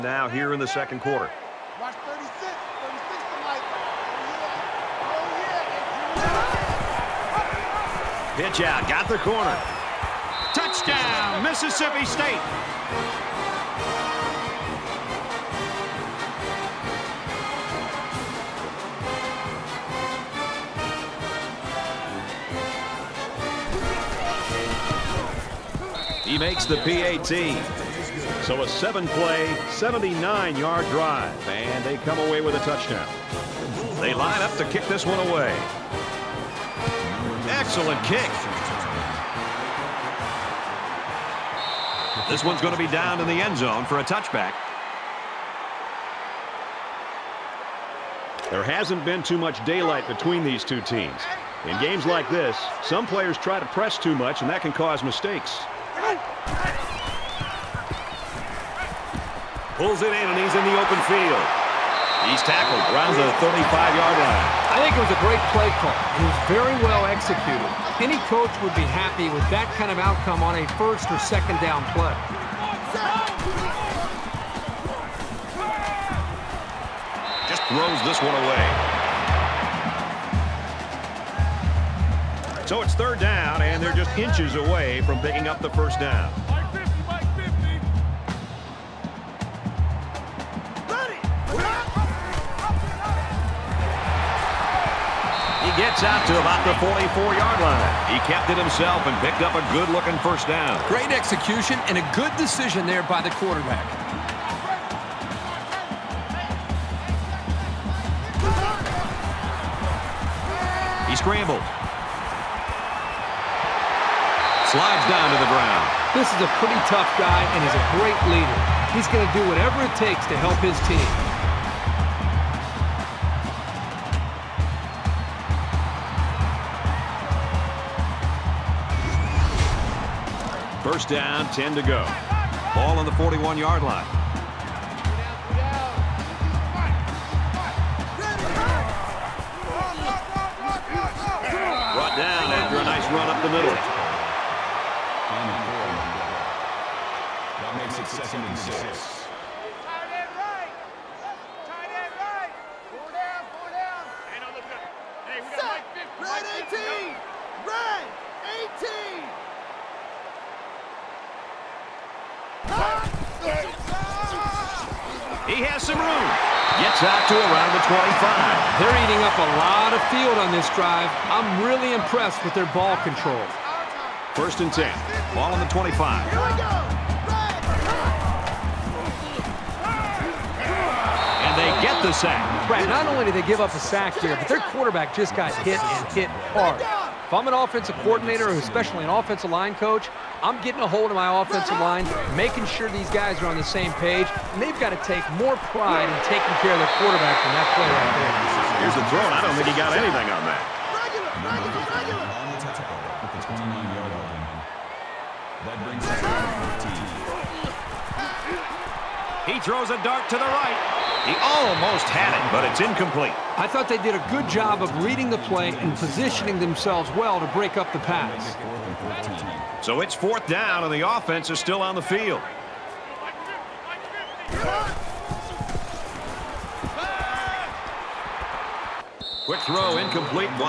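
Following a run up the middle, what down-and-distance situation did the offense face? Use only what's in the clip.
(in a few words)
Second and 6.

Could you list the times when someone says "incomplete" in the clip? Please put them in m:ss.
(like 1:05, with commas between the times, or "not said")
3:32, 3:49.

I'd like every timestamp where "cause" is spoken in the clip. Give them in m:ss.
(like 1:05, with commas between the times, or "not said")
0:54.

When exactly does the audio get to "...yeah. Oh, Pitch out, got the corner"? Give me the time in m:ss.
0:06.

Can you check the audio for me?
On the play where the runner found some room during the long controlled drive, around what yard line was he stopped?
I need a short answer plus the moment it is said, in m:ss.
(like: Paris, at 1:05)
25, at 2:47.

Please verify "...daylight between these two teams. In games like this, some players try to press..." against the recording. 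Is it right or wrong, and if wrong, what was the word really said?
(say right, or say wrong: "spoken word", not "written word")
right.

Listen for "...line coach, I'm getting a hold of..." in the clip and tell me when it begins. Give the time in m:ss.
3:09.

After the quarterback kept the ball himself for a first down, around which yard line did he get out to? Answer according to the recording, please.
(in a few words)
44.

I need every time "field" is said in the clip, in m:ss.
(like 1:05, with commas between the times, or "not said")
1:01, 2:50, 3:42.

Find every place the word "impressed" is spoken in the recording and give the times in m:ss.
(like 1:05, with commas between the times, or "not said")
2:51.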